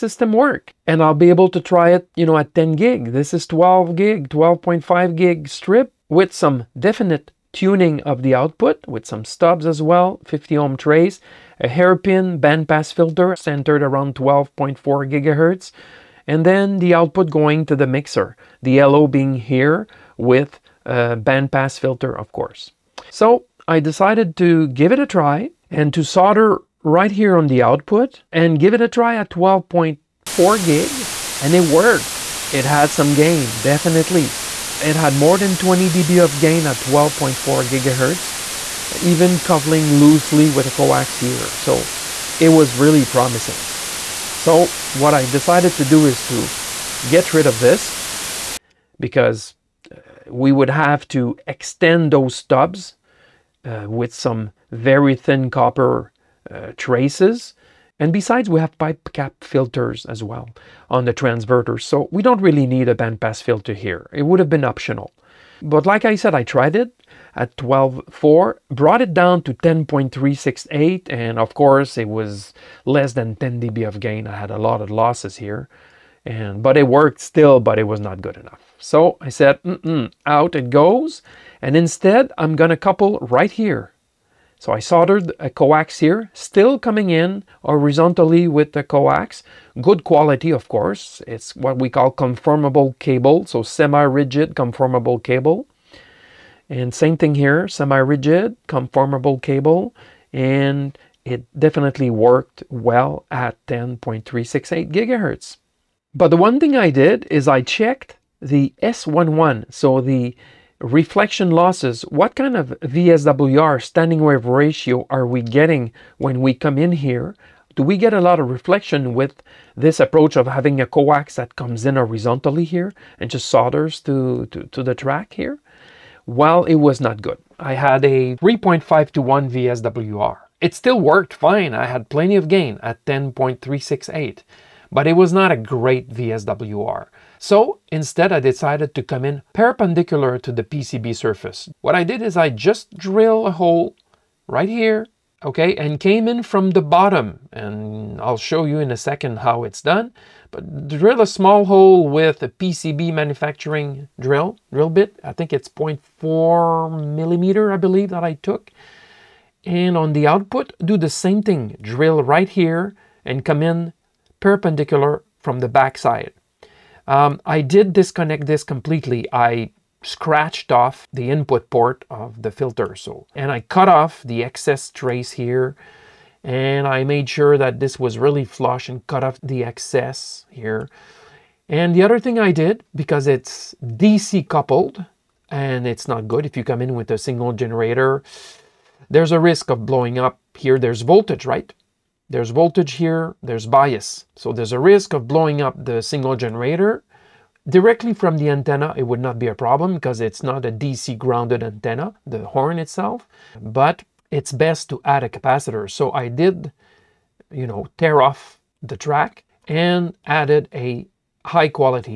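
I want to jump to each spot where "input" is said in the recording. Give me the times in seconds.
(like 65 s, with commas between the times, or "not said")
171 s.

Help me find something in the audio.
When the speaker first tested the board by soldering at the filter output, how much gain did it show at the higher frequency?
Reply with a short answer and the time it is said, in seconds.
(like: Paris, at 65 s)
More than 20 dB, at 35 s.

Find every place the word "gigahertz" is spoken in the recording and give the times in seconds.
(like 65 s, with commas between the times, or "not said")
15 s, 37 s, 104 s.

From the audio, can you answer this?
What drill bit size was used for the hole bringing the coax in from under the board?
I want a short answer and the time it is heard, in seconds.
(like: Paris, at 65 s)
0.4 mm, at 155 s.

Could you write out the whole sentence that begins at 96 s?
And same thing here, semi-rigid conformable cable.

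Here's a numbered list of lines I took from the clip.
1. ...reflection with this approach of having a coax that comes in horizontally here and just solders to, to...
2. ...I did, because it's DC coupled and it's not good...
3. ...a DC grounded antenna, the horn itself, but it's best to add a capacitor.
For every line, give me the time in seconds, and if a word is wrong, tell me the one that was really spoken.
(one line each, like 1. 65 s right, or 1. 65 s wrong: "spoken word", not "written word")
1. 118 s right
2. 182 s right
3. 200 s right.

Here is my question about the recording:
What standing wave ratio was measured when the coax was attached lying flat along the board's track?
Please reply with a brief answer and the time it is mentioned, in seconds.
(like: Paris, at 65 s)
3.5 to 1, at 128 s.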